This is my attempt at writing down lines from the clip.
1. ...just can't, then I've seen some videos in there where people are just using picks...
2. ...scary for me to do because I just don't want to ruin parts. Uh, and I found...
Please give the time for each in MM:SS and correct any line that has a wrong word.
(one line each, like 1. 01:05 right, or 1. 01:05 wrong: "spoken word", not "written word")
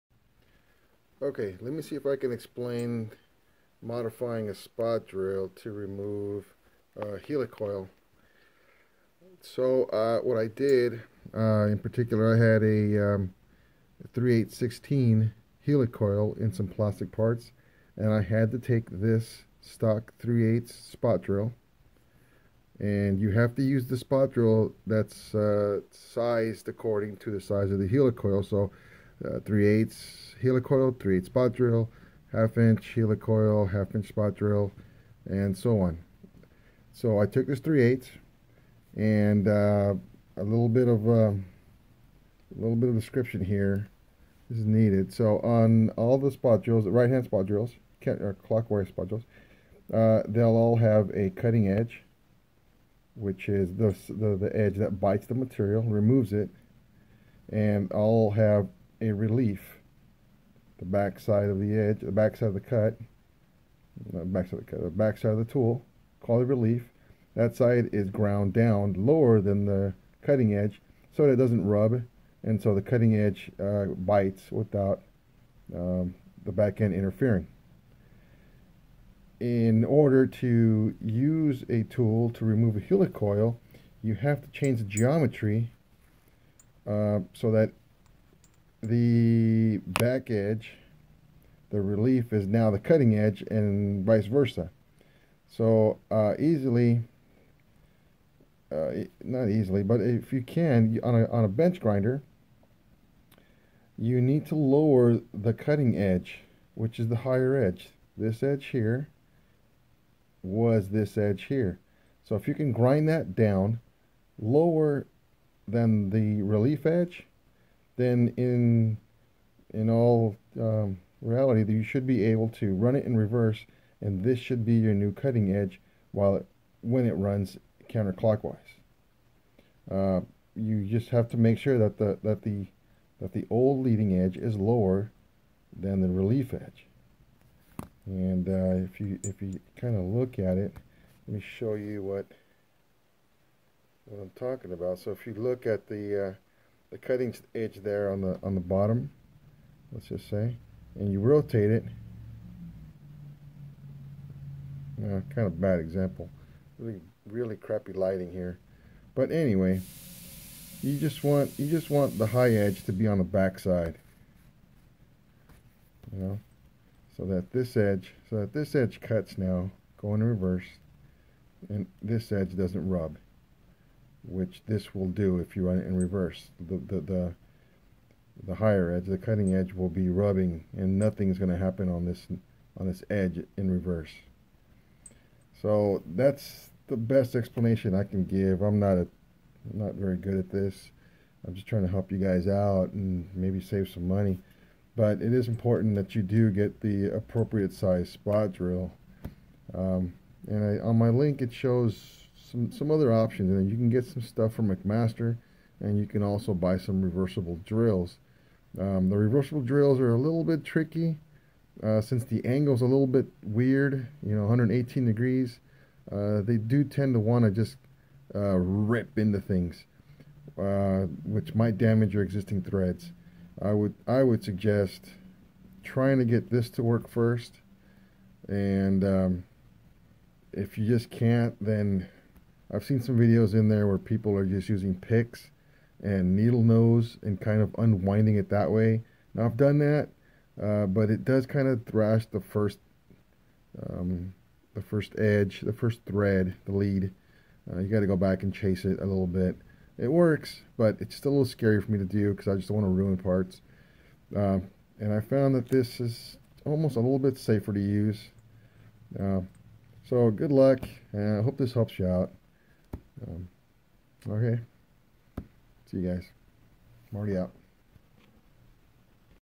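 1. 03:50 right
2. 04:11 right.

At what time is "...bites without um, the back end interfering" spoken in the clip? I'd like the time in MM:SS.
01:13.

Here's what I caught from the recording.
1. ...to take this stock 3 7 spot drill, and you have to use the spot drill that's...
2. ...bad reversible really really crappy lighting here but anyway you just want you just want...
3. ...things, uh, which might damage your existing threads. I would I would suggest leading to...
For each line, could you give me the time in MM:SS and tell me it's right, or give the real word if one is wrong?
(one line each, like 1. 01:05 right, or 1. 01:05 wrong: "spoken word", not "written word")
1. 00:18 wrong: "8", not "7"
2. 02:35 wrong: "example", not "reversible"
3. 03:39 wrong: "trying", not "leading".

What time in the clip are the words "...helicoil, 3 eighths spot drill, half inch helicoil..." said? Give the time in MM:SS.
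00:30.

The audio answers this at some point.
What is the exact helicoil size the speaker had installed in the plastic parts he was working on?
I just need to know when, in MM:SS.
00:14.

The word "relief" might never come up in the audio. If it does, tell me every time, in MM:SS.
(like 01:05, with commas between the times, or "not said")
00:59, 01:06, 01:31, 01:56, 02:16.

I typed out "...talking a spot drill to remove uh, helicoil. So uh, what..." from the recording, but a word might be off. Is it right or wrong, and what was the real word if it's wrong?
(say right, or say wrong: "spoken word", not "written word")
wrong: "modifying", not "talking".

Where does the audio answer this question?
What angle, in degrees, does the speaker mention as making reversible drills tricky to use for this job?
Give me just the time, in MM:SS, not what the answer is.
03:34.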